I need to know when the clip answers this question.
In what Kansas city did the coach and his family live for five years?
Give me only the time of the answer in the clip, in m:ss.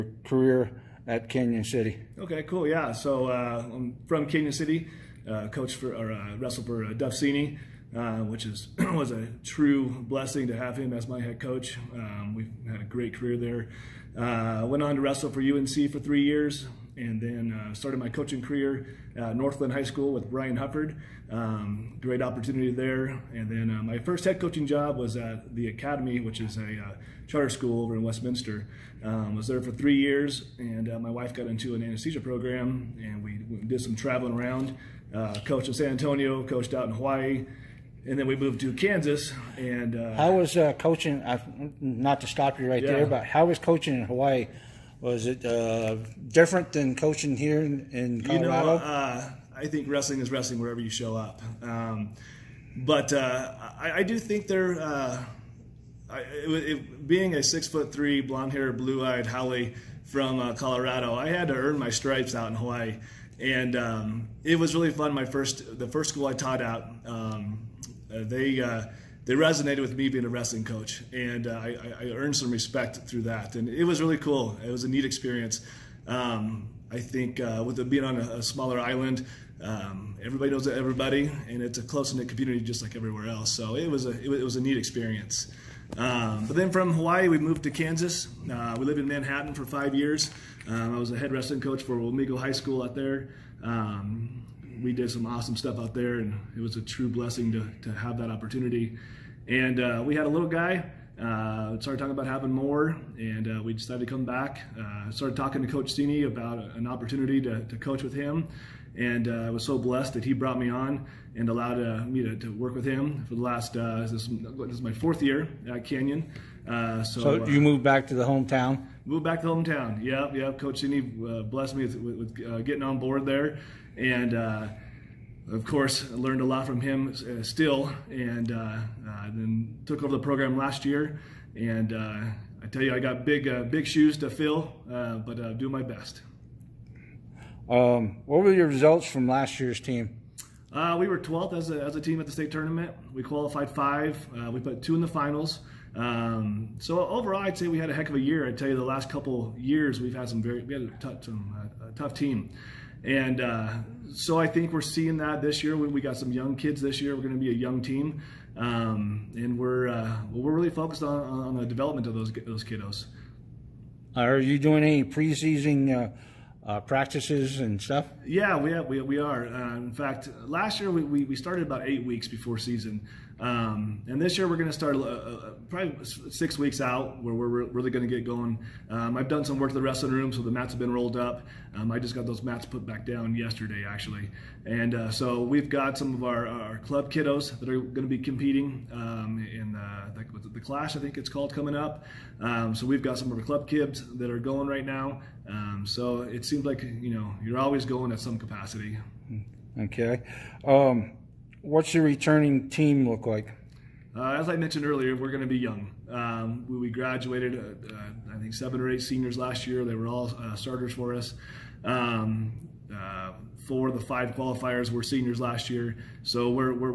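1:29.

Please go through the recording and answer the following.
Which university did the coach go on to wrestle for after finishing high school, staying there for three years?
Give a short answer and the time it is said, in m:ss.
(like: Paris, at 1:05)
UNC, at 0:15.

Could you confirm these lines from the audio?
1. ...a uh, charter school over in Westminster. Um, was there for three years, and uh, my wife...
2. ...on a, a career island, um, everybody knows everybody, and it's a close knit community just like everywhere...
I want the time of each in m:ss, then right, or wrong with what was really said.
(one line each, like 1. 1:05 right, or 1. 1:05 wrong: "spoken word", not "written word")
1. 0:26 right
2. 1:18 wrong: "smaller", not "career".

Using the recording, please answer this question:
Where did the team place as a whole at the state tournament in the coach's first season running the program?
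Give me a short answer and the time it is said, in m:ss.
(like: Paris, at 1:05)
12th, at 2:21.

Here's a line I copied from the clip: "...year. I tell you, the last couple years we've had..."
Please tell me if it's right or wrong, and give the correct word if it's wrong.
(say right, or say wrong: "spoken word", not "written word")
right.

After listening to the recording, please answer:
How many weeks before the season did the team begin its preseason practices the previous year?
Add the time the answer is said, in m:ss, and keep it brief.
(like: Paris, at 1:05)
8, at 2:51.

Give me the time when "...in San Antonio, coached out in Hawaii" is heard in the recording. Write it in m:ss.
0:35.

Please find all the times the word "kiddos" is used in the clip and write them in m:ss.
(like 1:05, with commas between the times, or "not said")
2:42, 3:07.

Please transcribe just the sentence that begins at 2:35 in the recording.
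We, we got some young kids this year.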